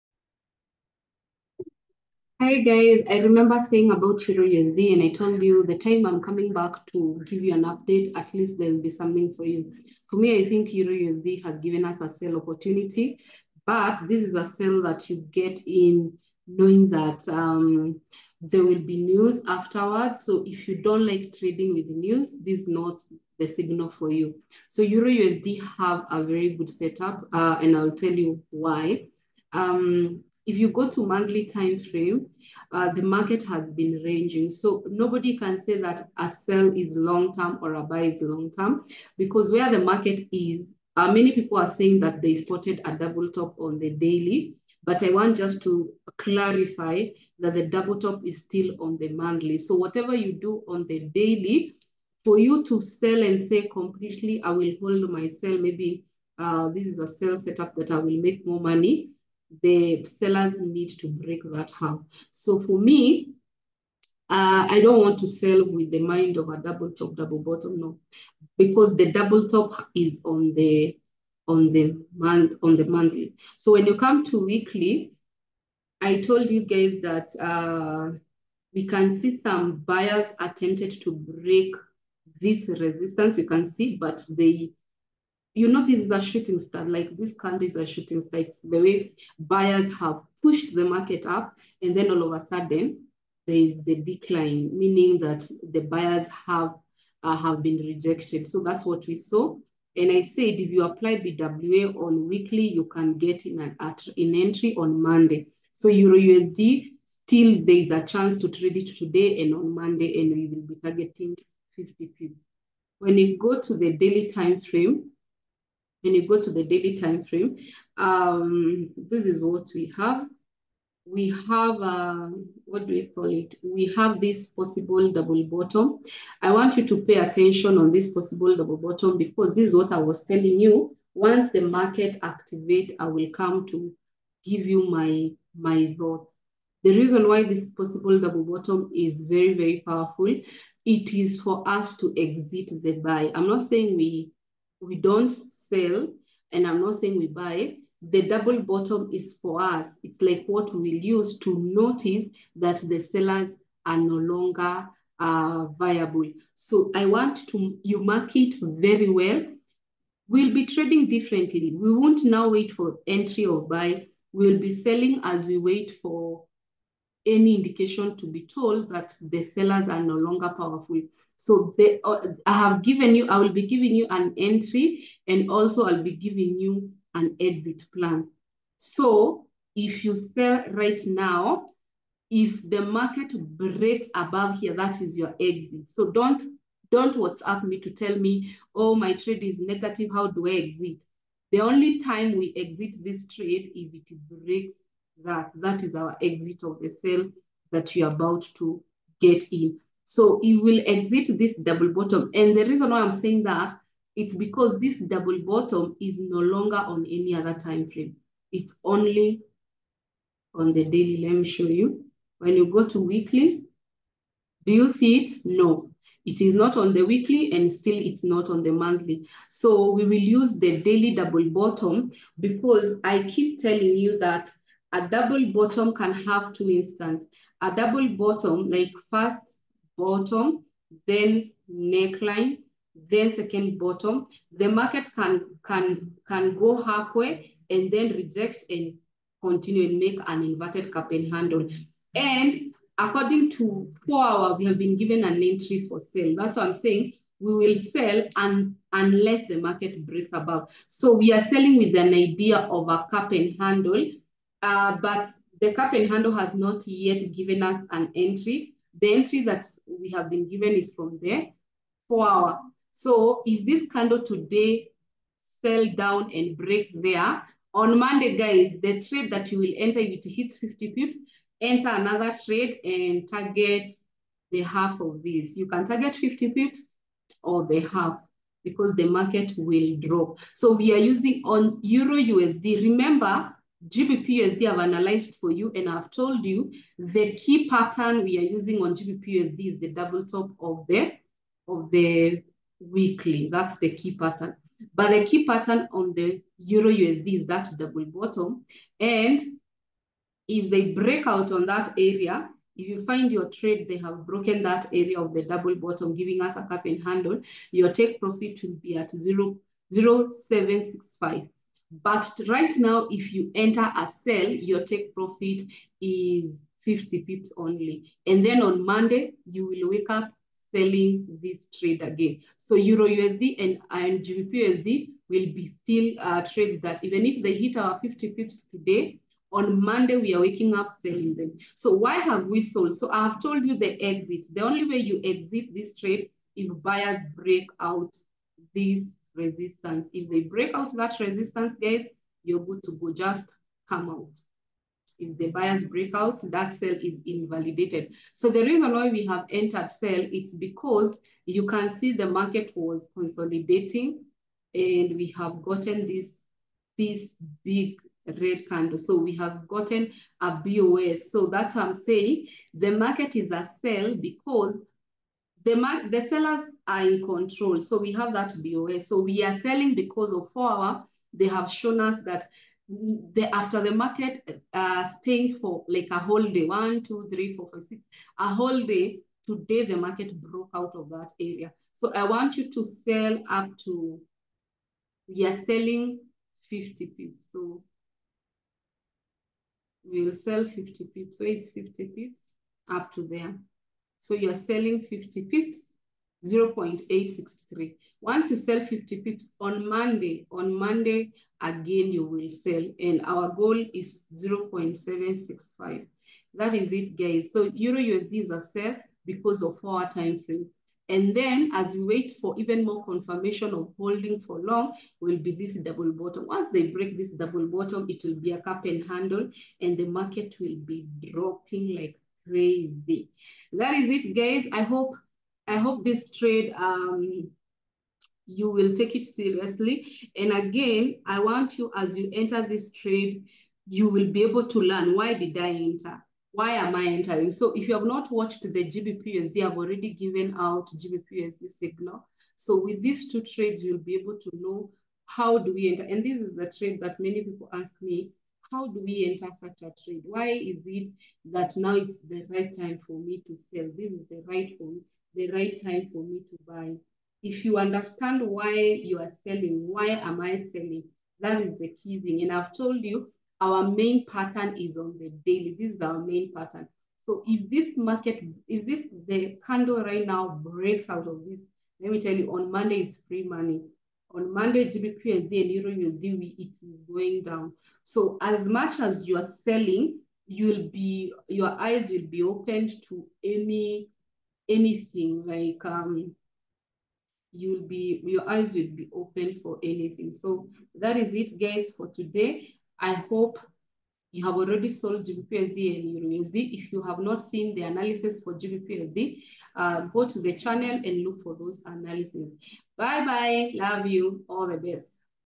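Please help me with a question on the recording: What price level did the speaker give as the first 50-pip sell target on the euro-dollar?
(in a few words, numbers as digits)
0.863.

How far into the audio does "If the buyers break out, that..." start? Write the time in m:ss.
5:45.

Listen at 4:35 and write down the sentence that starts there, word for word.
You can target 50 pips or the half because the market will drop.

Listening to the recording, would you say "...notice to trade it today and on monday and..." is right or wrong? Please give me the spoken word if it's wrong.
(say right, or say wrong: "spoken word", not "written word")
wrong: "chance", not "notice".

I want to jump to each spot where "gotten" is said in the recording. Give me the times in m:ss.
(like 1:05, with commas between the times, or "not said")
5:55, 5:59.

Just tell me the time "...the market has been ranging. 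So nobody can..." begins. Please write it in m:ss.
0:32.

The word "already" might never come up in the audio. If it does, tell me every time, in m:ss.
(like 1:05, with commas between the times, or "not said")
7:19, 8:14.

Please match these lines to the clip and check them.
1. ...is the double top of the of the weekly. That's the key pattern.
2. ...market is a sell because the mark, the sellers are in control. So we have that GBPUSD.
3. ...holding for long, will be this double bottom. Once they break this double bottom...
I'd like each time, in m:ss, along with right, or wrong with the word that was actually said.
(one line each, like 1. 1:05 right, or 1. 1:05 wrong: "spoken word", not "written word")
1. 4:49 right
2. 6:02 wrong: "BOA", not "GBPUSD"
3. 6:53 right.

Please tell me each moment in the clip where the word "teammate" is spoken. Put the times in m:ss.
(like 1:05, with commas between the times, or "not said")
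not said.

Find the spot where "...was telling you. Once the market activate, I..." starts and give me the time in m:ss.
2:09.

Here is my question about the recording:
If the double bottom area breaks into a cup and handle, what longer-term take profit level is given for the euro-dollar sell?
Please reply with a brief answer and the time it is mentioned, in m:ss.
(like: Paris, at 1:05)
0.765, at 5:09.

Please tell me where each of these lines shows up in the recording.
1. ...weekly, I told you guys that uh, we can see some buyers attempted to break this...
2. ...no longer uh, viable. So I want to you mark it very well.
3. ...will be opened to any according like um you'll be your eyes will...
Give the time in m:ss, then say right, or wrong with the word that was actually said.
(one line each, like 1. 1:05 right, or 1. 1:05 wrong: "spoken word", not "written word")
1. 1:14 right
2. 2:33 right
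3. 8:02 wrong: "anything", not "according".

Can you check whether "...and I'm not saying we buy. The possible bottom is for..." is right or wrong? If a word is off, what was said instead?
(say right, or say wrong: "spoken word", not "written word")
wrong: "double", not "possible".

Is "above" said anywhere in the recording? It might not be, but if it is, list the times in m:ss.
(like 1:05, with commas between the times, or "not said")
3:04, 4:10.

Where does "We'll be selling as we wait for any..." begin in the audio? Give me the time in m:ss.
2:44.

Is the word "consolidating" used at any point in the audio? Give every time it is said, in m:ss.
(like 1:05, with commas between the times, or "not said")
5:53.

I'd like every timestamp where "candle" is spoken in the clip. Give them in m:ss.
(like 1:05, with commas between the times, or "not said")
1:27, 4:23, 5:58, 7:49.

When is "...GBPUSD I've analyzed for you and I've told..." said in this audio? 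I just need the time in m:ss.
4:43.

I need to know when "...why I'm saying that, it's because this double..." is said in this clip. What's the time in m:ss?
3:22.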